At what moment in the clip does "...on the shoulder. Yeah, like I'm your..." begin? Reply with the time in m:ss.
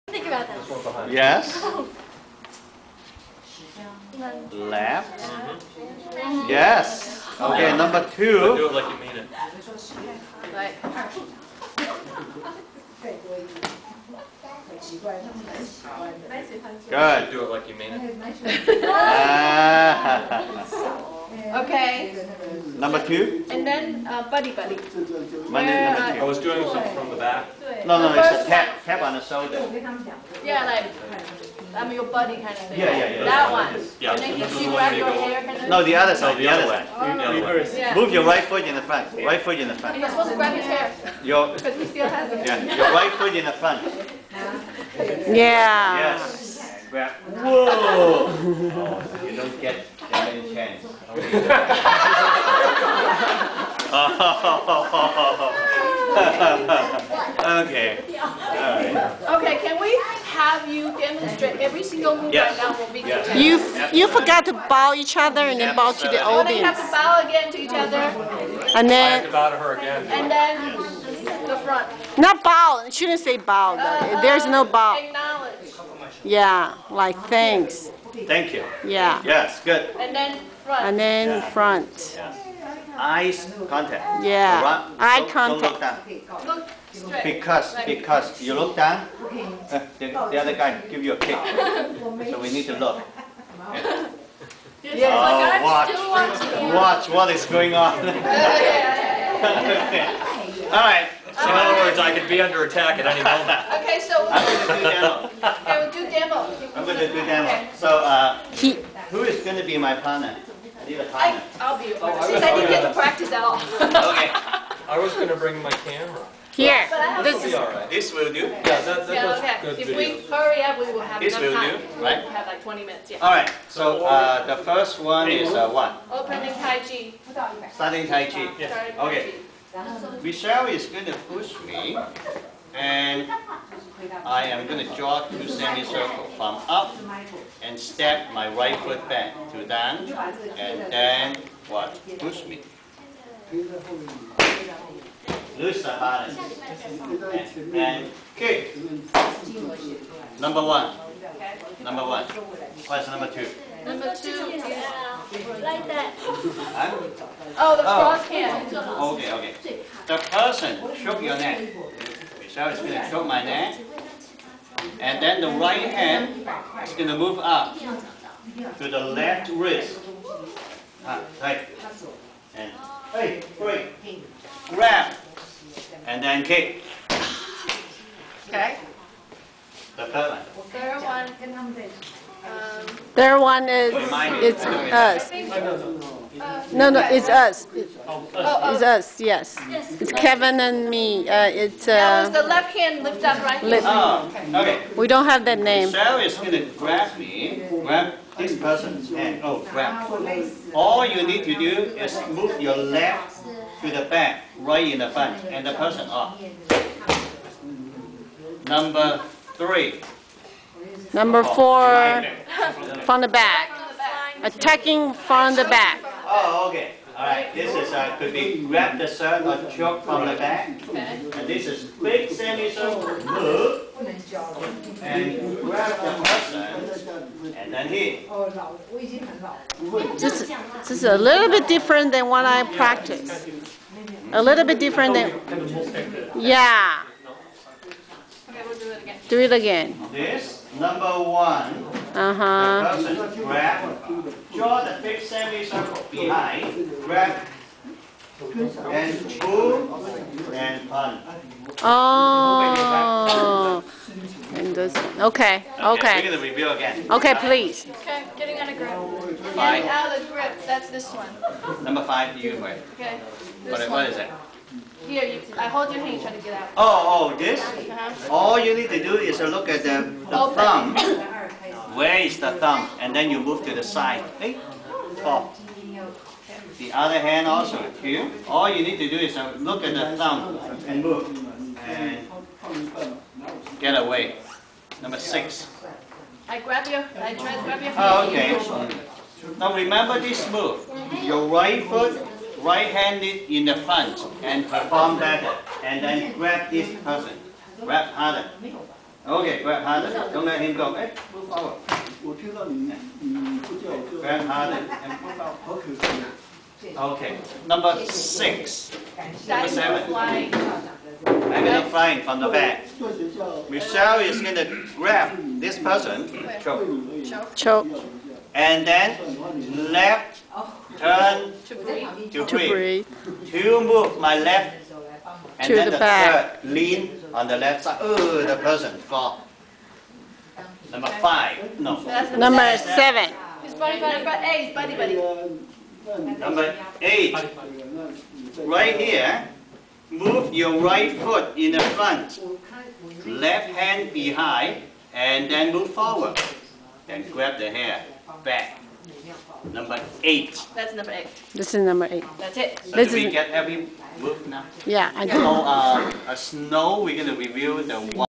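0:29.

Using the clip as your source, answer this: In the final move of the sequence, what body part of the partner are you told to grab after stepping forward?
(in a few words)
the hair.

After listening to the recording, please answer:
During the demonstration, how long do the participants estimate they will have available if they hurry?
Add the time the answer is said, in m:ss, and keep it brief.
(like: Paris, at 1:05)
20 minutes, at 2:02.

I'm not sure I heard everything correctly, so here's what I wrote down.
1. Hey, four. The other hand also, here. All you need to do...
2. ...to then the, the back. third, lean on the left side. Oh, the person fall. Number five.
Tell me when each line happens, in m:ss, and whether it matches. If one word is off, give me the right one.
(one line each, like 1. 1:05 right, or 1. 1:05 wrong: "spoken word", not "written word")
1. 4:34 right
2. 5:25 right.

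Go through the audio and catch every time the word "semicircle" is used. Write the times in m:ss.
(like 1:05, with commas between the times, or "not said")
2:15, 3:42, 4:05.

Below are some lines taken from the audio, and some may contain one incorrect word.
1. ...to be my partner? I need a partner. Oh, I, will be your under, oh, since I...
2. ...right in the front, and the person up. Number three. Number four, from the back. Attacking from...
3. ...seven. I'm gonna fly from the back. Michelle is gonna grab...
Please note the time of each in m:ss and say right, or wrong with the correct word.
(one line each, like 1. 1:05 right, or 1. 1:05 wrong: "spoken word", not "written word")
1. 1:49 wrong: "partner", not "under"
2. 3:24 right
3. 5:09 right.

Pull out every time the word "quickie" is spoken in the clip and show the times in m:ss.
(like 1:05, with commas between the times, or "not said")
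not said.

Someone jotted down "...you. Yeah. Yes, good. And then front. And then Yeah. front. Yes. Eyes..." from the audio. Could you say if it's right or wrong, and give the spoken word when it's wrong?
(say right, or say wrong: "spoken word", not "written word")
right.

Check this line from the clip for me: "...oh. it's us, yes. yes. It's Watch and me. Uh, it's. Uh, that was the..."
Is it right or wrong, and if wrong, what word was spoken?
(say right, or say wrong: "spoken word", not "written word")
wrong: "Kevin", not "Watch".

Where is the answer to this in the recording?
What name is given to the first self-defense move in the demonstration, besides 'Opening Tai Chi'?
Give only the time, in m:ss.
2:07.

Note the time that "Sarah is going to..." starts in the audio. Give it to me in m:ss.
3:15.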